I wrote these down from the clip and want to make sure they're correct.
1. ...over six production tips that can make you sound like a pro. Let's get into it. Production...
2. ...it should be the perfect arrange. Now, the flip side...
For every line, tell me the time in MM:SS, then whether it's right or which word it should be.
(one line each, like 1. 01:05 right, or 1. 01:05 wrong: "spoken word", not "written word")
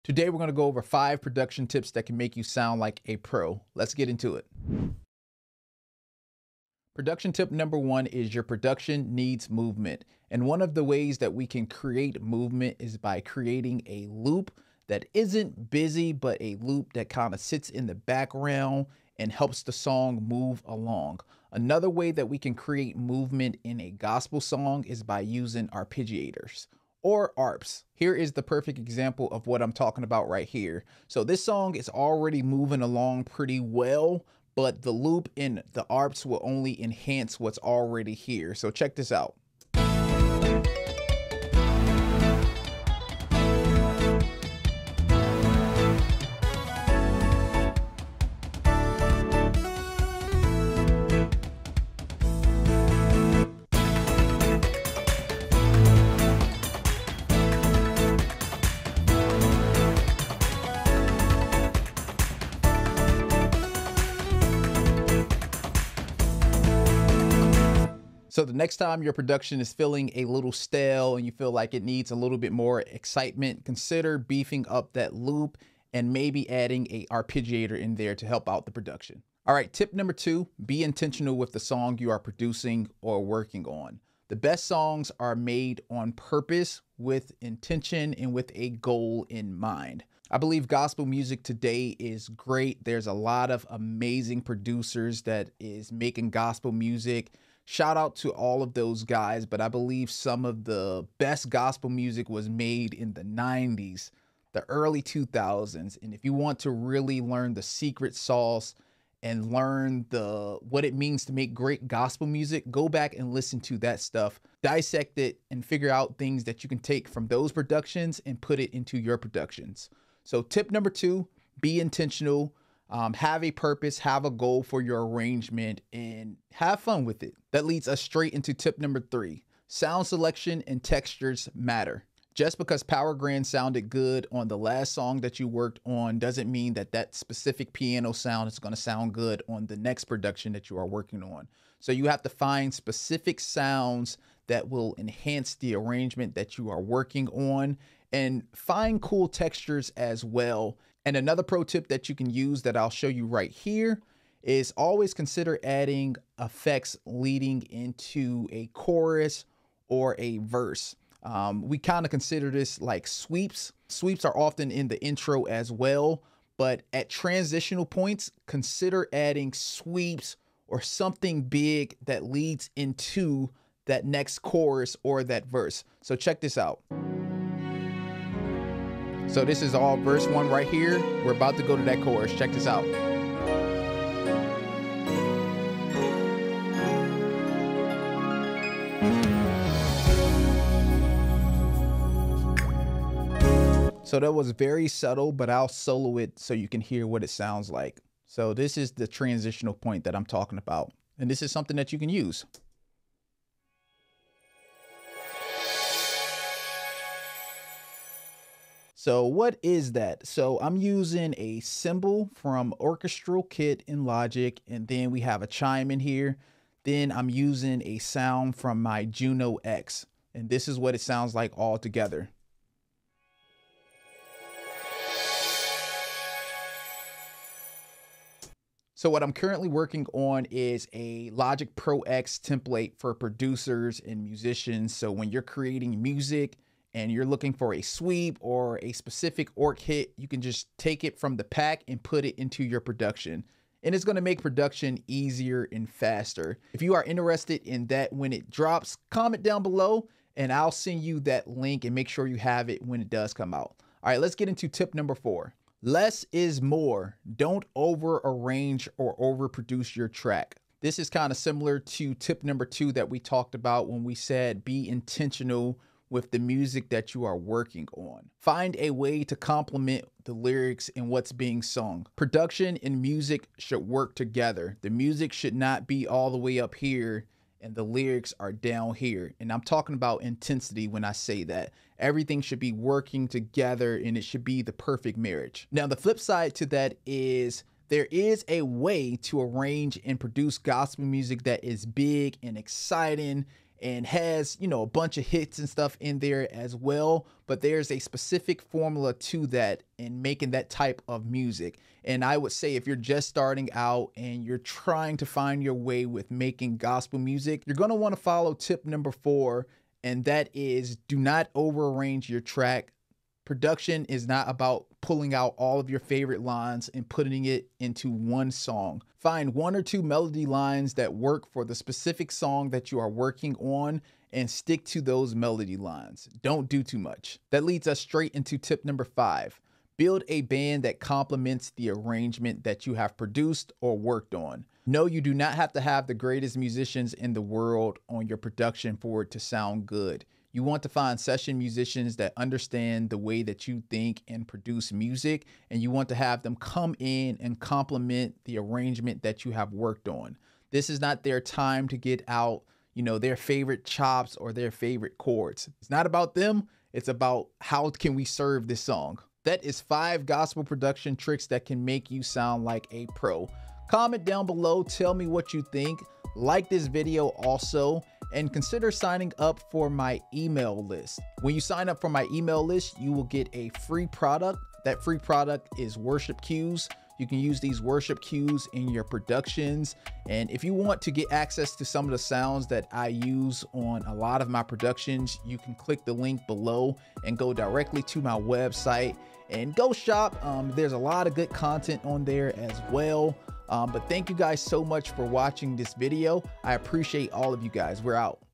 1. 00:00 wrong: "five", not "six"
2. 04:44 wrong: "marriage", not "arrange".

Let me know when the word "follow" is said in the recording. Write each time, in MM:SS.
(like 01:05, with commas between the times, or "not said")
05:08.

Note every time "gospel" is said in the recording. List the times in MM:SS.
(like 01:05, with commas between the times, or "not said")
00:23, 01:30, 01:36, 01:41, 01:51, 04:50, 05:06, 06:00.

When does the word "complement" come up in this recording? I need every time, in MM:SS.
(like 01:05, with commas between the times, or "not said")
04:29, 05:30, 05:47.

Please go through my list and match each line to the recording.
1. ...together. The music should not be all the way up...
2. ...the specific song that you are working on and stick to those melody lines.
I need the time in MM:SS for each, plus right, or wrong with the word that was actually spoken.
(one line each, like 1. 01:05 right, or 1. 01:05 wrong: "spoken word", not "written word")
1. 04:34 right
2. 05:21 right.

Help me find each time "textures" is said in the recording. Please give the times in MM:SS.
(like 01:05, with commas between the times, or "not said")
02:10, 02:29.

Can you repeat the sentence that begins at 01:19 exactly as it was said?
All right, tip number two, be intentional with the song you are producing or working on.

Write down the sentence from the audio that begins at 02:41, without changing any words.
Um, we kind of consider this like sweeps.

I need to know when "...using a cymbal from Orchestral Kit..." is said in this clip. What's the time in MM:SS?
03:30.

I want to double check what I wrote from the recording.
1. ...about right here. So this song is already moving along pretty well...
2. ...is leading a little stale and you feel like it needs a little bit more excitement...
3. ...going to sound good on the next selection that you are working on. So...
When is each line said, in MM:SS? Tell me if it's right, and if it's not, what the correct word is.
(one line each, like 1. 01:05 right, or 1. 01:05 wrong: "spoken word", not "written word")
1. 00:30 right
2. 01:09 wrong: "feeling", not "leading"
3. 02:18 wrong: "production", not "selection".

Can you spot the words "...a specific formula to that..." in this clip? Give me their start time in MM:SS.
04:57.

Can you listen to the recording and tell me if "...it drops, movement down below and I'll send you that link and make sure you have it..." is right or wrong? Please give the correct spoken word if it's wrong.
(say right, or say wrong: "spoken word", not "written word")
wrong: "comment", not "movement".